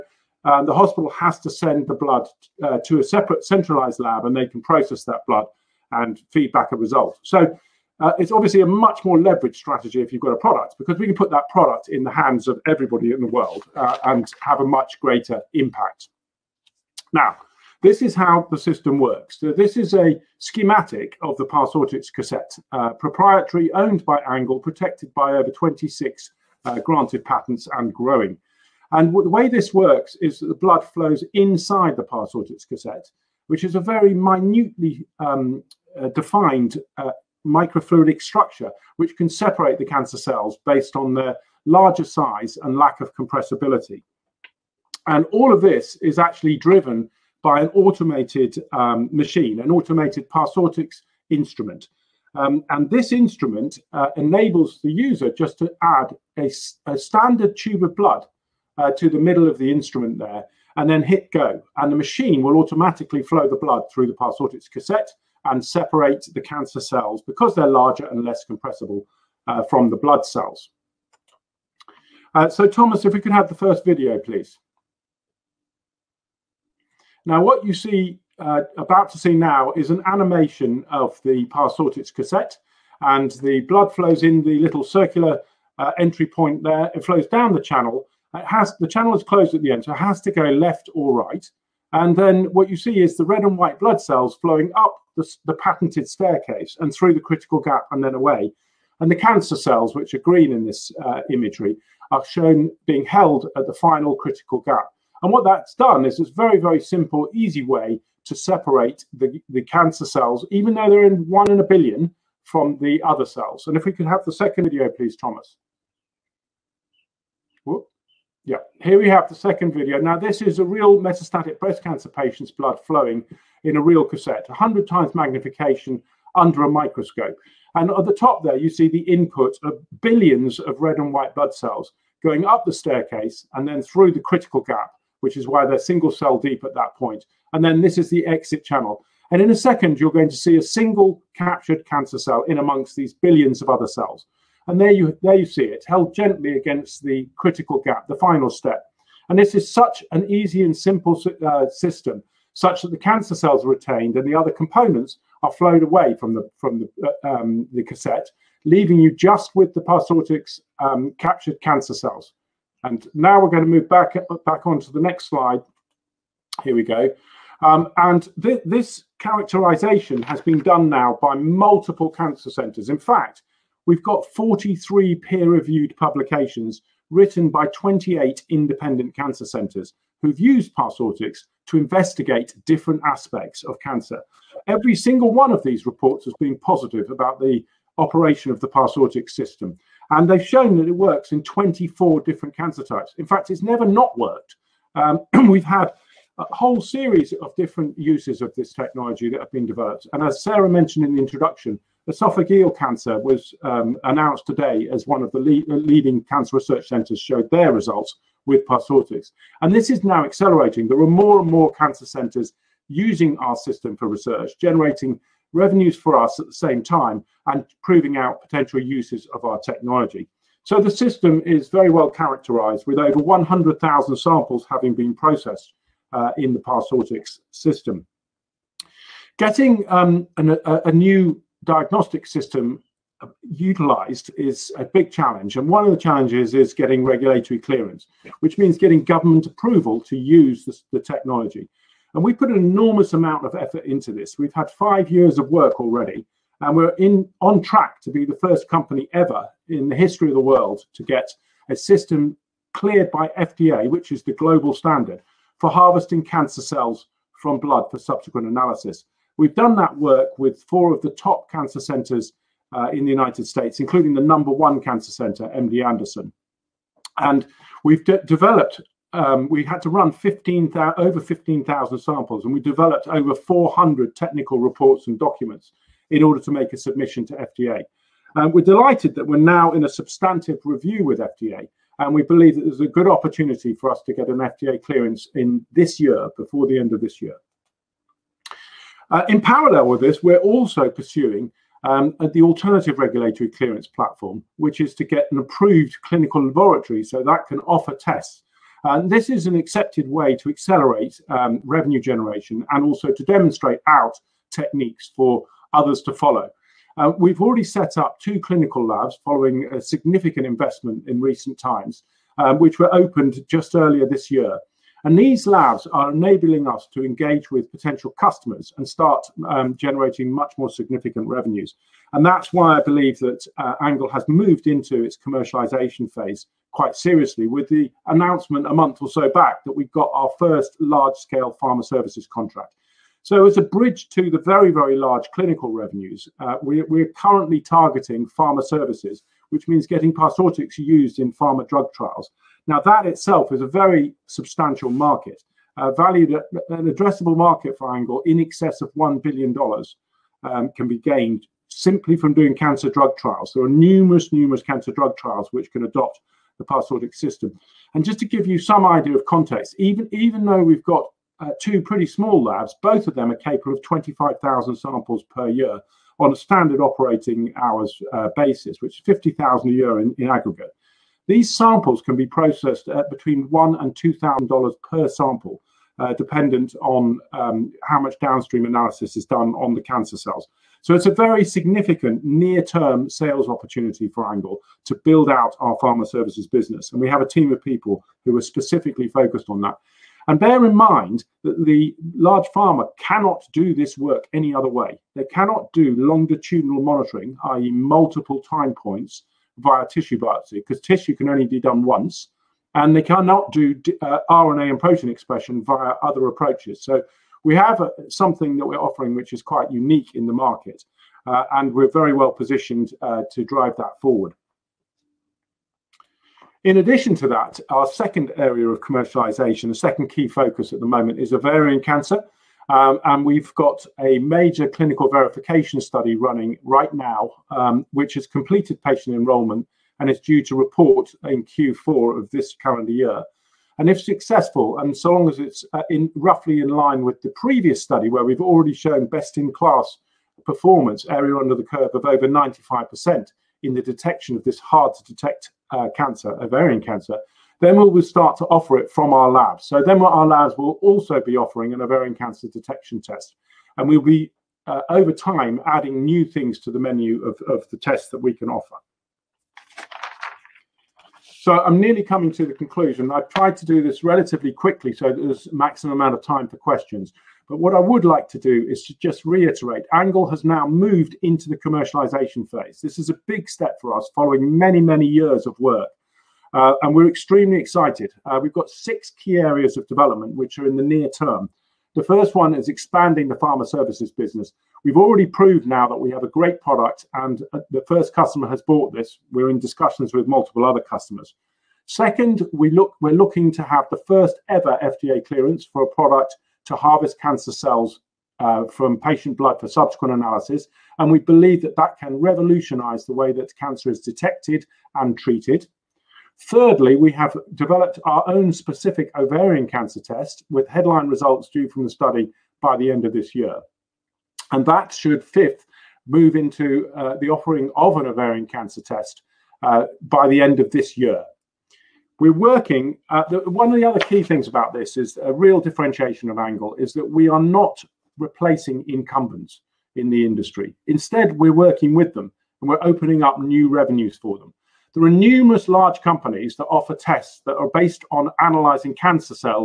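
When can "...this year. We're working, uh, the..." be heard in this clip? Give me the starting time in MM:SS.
08:40.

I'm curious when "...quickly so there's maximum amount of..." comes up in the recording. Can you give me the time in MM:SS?
07:44.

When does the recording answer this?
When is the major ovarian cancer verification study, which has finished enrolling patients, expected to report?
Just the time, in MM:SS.
07:11.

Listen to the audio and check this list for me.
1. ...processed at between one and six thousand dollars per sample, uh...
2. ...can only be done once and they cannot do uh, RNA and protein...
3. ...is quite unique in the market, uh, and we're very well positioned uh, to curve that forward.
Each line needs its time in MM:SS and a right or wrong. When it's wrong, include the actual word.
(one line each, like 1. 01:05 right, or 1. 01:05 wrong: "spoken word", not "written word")
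1. 06:12 wrong: "two", not "six"
2. 06:41 right
3. 06:49 wrong: "drive", not "curve".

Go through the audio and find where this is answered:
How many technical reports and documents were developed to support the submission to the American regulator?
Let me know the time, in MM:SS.
04:33.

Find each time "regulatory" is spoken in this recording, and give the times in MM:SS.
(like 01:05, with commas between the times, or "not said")
03:57, 04:52.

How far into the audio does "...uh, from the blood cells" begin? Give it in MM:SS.
01:09.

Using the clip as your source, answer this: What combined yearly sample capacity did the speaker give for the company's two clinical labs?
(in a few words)
50,000.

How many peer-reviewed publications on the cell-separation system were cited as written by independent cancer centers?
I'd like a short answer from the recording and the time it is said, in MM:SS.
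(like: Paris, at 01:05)
43, at 02:54.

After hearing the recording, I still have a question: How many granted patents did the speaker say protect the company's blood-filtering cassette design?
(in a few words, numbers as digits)
26.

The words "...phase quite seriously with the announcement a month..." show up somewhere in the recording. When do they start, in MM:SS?
05:26.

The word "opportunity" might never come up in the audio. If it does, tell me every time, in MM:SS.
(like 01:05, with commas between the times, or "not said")
04:43, 06:23.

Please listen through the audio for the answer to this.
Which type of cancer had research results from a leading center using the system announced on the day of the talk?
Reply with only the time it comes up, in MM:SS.
03:22.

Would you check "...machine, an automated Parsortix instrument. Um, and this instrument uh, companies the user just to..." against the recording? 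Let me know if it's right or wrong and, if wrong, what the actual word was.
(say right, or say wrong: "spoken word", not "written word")
wrong: "enables", not "companies".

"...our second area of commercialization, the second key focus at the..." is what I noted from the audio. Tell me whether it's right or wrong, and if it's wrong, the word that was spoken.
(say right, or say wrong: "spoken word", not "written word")
right.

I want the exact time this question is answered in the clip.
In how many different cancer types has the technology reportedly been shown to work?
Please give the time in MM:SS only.
03:11.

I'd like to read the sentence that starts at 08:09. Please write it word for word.
We're in discussions with multiple other customers.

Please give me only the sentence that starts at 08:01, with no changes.
The first one is expanding the pharma services business.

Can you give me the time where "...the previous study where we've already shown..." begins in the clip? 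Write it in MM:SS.
07:17.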